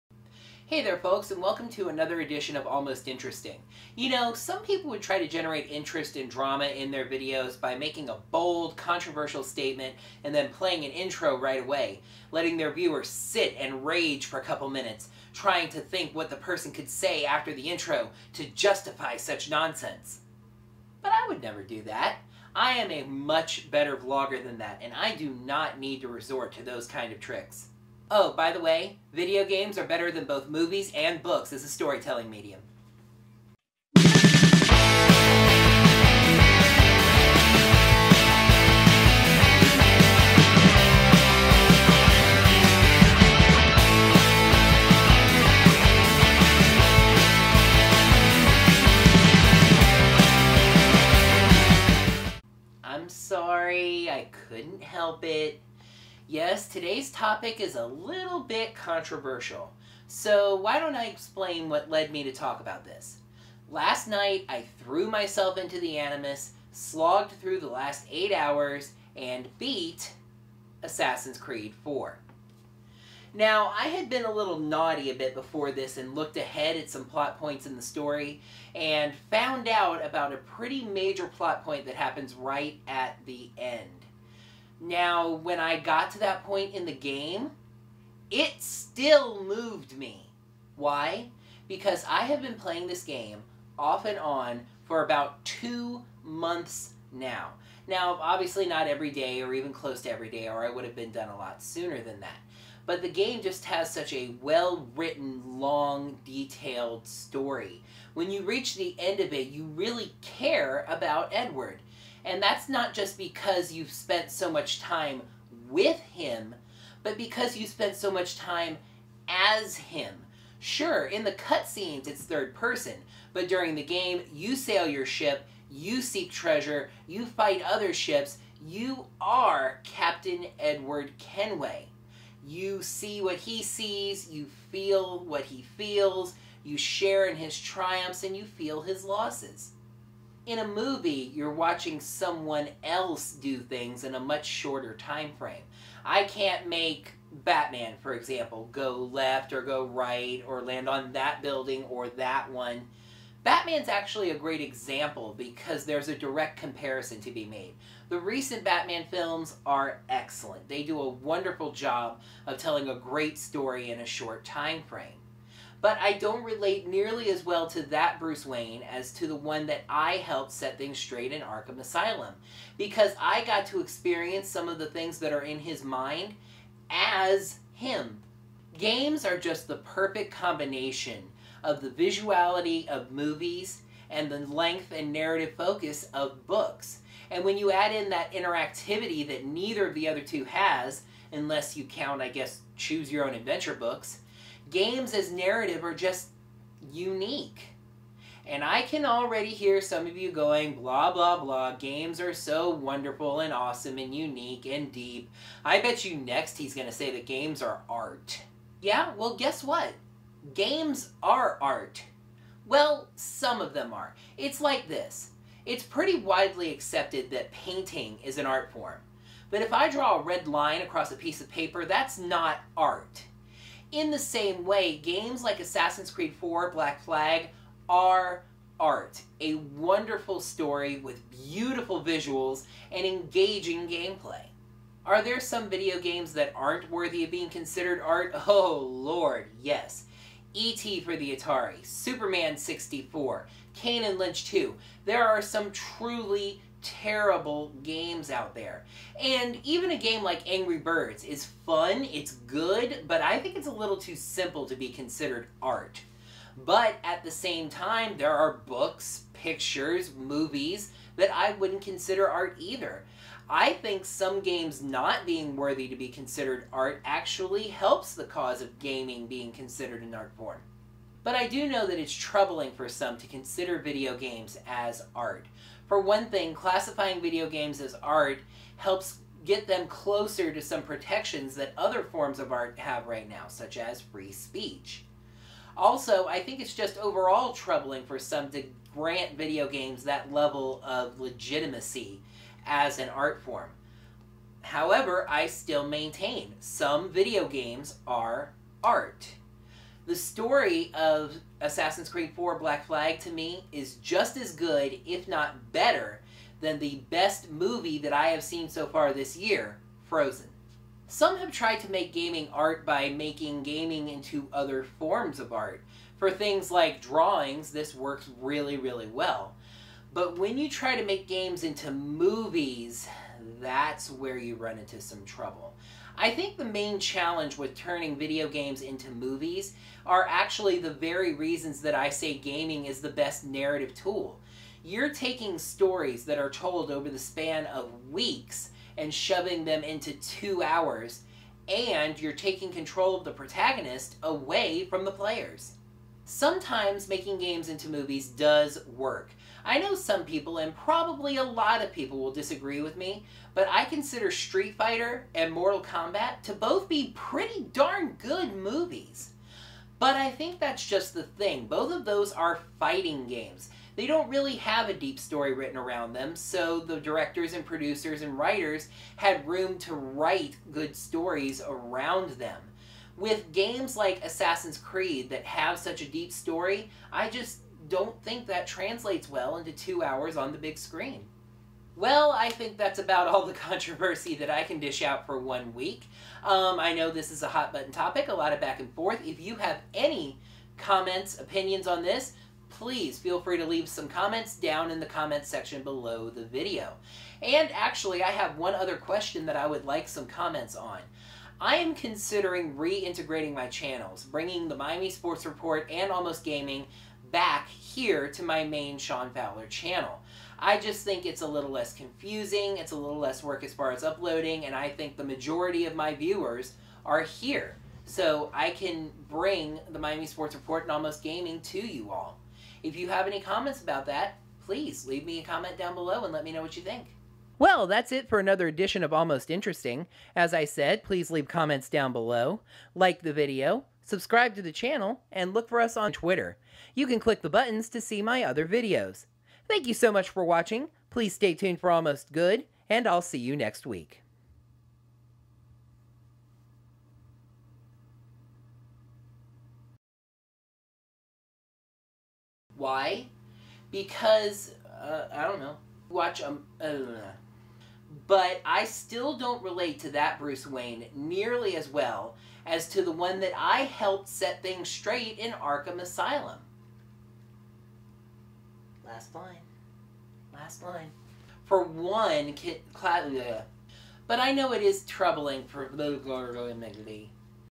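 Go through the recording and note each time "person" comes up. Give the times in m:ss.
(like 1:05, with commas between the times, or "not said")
0:16, 2:02.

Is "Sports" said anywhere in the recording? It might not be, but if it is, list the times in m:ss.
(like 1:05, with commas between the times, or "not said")
6:45, 7:00.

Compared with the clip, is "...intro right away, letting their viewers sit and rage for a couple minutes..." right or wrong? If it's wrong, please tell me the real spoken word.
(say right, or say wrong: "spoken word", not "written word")
right.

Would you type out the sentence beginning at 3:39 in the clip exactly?
But if I draw a red line across a piece of paper, that's not art.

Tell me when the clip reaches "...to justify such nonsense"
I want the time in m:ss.
0:18.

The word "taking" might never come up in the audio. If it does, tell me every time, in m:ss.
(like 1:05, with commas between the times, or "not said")
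5:35, 5:42.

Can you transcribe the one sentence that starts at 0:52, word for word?
I'm sorry, I couldn't help it.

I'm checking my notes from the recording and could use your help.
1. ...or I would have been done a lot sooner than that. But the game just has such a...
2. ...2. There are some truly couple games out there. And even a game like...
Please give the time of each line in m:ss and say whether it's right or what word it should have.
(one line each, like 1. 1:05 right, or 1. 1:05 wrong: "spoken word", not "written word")
1. 1:40 right
2. 4:04 wrong: "terrible", not "couple".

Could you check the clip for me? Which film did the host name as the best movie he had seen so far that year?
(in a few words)
Frozen.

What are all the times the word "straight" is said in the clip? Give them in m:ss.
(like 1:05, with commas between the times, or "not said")
2:50, 7:44.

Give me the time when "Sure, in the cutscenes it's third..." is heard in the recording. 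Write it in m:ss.
2:00.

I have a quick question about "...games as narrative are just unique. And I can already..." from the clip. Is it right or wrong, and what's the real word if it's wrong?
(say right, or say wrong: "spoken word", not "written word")
right.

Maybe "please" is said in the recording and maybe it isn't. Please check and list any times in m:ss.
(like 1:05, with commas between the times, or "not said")
6:32, 7:04, 7:11, 7:21.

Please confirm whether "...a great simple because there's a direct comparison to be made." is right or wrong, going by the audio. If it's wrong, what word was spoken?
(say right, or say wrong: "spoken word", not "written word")
wrong: "example", not "simple".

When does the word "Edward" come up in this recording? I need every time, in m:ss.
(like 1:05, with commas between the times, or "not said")
1:51, 2:10.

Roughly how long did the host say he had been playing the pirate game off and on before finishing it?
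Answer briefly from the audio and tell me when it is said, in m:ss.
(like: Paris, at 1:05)
2 months, at 1:35.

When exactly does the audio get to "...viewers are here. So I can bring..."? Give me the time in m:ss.
6:56.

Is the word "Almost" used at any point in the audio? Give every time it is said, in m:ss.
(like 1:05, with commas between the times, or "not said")
0:02, 6:46, 7:00, 7:09, 7:21.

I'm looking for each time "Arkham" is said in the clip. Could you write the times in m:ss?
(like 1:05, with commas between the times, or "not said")
2:51, 7:45.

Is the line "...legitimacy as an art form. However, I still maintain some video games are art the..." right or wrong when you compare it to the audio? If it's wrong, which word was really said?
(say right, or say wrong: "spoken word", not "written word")
right.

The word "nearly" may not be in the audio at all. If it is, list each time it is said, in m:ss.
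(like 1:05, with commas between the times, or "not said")
2:46, 7:41.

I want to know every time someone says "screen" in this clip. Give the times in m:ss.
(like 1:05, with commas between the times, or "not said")
6:20.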